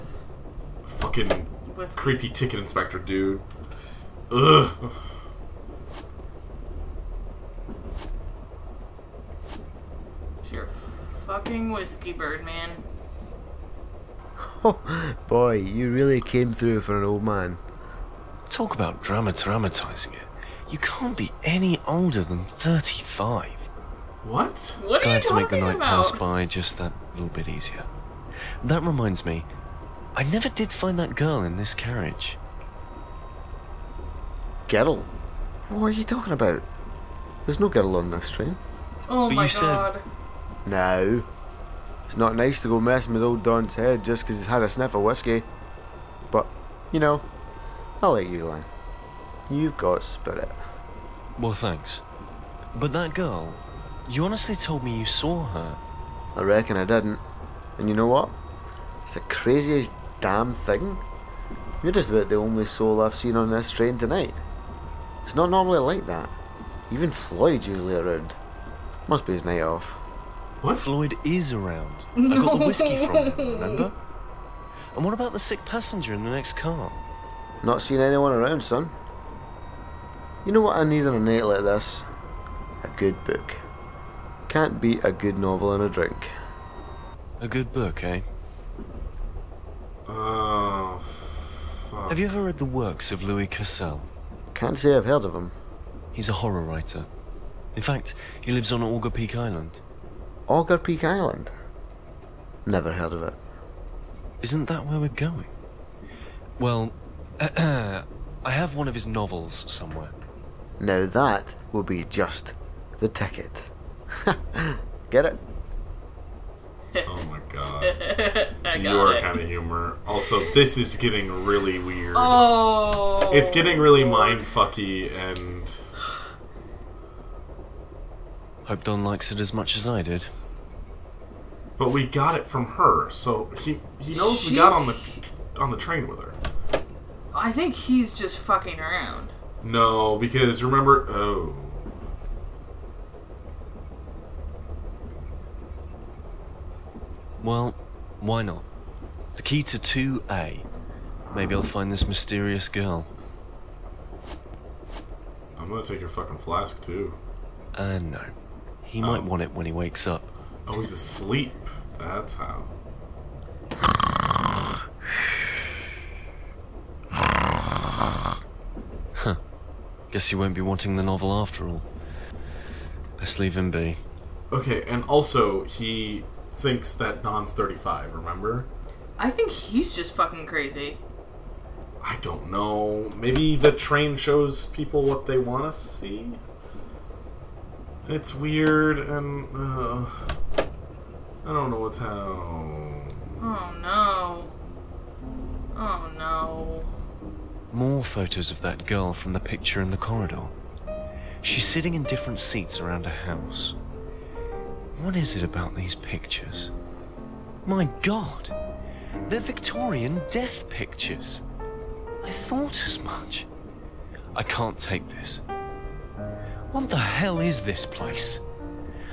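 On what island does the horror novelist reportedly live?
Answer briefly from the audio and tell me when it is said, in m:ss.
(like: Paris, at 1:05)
Augur Peak Island, at 1:38.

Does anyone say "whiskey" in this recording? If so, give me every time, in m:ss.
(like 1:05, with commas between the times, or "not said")
0:01, 0:11, 0:45, 1:12.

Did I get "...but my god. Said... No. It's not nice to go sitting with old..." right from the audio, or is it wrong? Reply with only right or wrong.
wrong.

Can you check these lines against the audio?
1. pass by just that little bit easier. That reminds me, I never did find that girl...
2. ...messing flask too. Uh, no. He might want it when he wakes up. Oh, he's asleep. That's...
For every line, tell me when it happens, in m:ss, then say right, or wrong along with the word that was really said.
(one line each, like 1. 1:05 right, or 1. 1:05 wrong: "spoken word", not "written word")
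1. 0:25 right
2. 2:36 wrong: "fucking", not "messing".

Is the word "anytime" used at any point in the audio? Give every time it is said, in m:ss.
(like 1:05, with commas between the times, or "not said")
not said.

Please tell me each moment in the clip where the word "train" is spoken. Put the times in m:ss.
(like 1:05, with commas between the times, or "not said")
0:38, 1:03, 2:15, 3:03.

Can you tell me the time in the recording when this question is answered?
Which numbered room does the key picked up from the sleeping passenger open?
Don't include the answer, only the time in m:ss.
2:29.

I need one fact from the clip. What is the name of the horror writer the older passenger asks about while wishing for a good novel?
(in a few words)
Louis Cassel.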